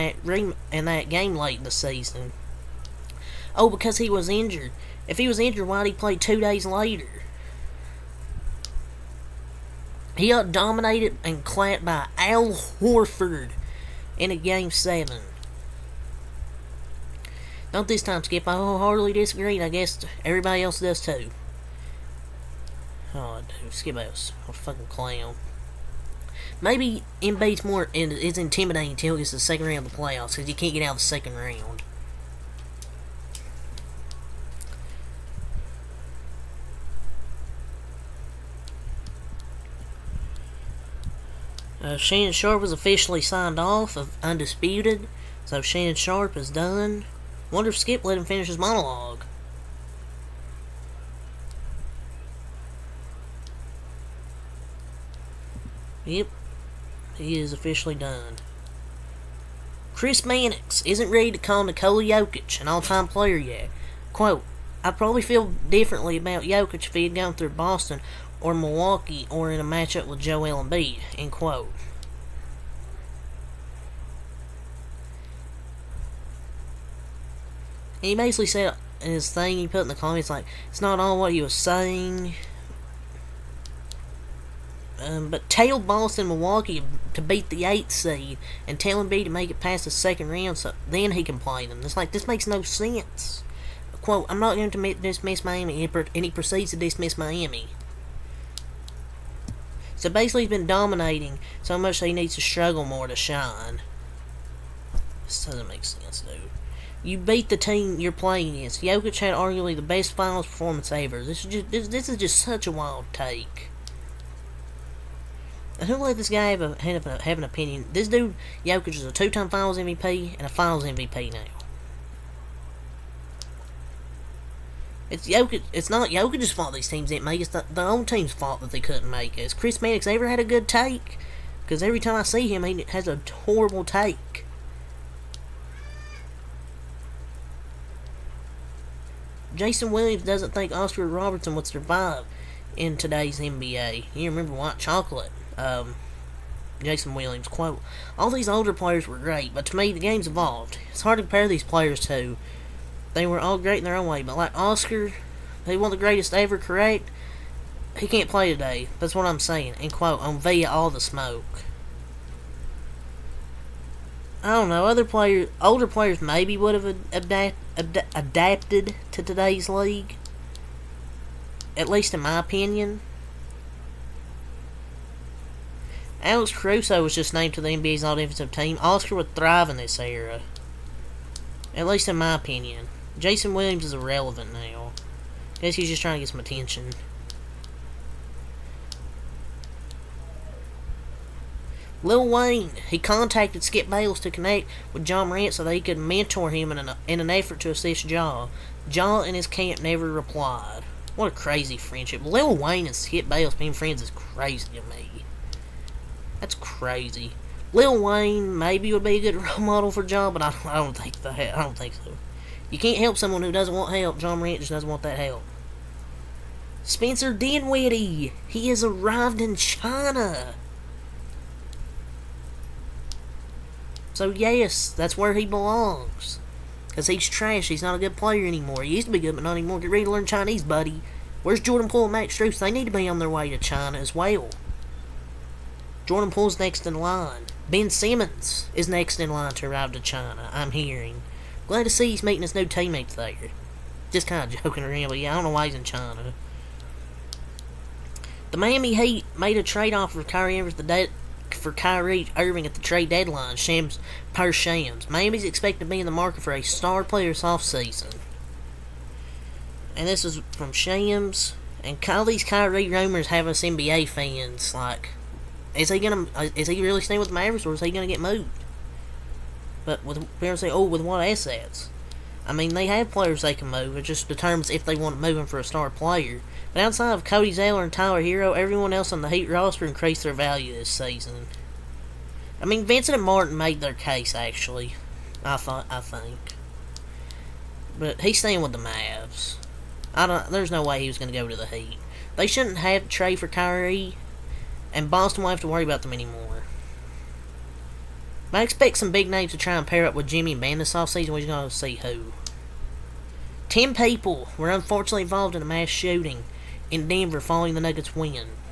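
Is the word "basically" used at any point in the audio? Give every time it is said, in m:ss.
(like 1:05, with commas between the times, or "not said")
1:18, 1:40.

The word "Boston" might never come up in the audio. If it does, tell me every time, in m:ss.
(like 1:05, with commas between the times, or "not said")
1:07, 1:25, 4:55.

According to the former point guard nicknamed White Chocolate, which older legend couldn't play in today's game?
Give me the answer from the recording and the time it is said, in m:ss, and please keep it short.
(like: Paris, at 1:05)
Oscar Robertson, at 2:20.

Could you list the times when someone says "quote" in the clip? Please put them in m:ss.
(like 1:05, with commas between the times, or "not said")
1:04, 1:11, 1:34, 2:27, 2:39.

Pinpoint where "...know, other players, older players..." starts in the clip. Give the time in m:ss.
2:44.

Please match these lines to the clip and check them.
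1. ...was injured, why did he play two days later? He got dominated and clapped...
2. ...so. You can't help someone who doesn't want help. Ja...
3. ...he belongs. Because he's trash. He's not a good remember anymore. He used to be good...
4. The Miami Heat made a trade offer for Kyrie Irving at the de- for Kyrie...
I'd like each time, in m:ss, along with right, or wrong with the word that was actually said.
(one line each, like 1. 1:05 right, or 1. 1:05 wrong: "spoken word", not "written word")
1. 0:05 right
2. 3:31 right
3. 3:45 wrong: "player", not "remember"
4. 4:08 right.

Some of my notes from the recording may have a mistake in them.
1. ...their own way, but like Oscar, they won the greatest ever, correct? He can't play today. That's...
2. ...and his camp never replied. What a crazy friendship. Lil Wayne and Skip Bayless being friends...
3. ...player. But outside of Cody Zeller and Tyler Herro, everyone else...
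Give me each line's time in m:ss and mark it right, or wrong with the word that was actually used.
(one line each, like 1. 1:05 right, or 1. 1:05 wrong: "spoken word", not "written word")
1. 2:33 right
2. 3:19 right
3. 4:35 right.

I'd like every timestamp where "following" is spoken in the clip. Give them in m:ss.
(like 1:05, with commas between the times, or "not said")
5:07.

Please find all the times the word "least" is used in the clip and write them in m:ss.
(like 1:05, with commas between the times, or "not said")
2:51, 3:01.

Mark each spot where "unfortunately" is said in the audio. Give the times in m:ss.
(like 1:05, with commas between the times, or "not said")
5:04.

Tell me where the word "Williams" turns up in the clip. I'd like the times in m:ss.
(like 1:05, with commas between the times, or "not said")
2:19, 2:27, 3:03.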